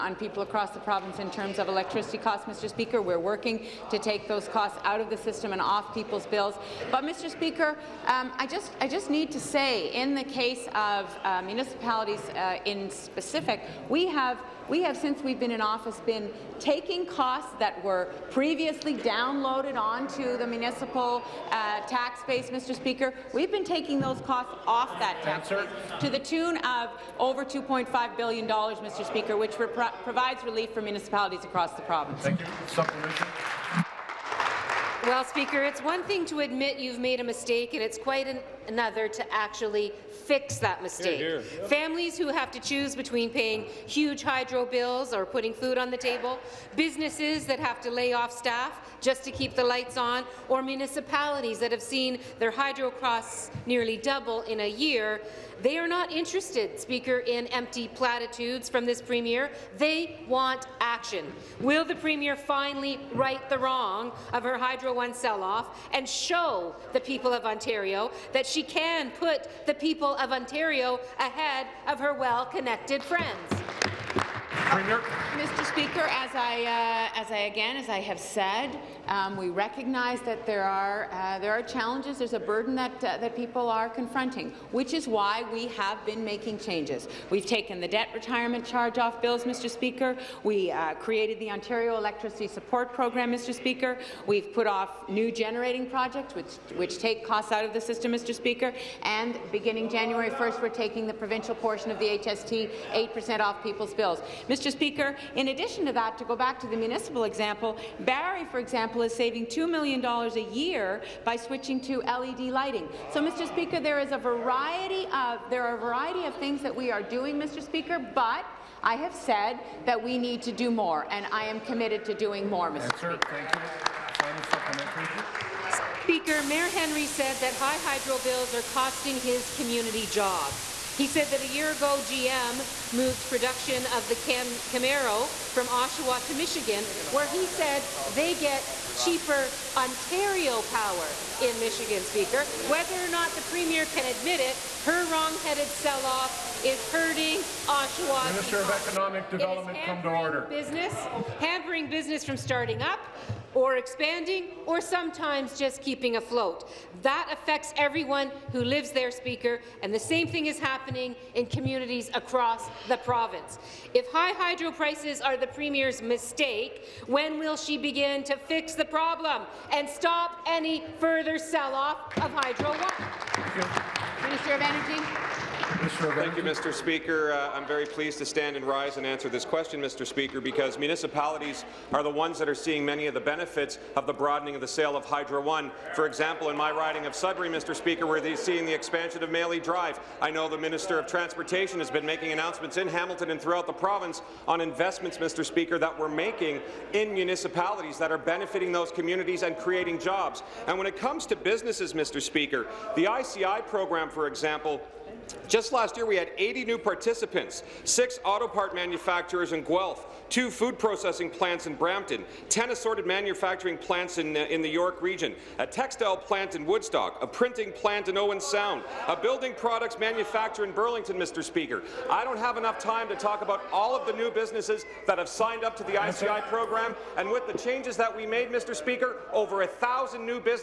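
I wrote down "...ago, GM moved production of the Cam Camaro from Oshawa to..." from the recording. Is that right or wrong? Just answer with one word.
right.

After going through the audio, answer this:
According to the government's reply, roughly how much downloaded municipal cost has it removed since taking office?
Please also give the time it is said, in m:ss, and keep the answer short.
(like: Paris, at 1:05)
$2.5 billion, at 0:27.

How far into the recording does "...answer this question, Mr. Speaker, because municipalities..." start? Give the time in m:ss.
2:59.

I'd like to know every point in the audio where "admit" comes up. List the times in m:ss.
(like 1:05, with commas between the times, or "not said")
0:36, 2:24.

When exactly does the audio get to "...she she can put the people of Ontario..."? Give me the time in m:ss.
1:08.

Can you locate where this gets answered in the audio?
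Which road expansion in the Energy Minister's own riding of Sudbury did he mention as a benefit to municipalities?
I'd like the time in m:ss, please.
3:09.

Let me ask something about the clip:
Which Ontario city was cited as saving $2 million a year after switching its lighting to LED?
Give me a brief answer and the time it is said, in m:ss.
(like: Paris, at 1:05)
Barrie, at 1:47.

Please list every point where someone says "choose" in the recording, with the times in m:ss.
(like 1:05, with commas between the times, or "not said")
0:42.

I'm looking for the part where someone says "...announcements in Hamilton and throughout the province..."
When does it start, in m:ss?
3:12.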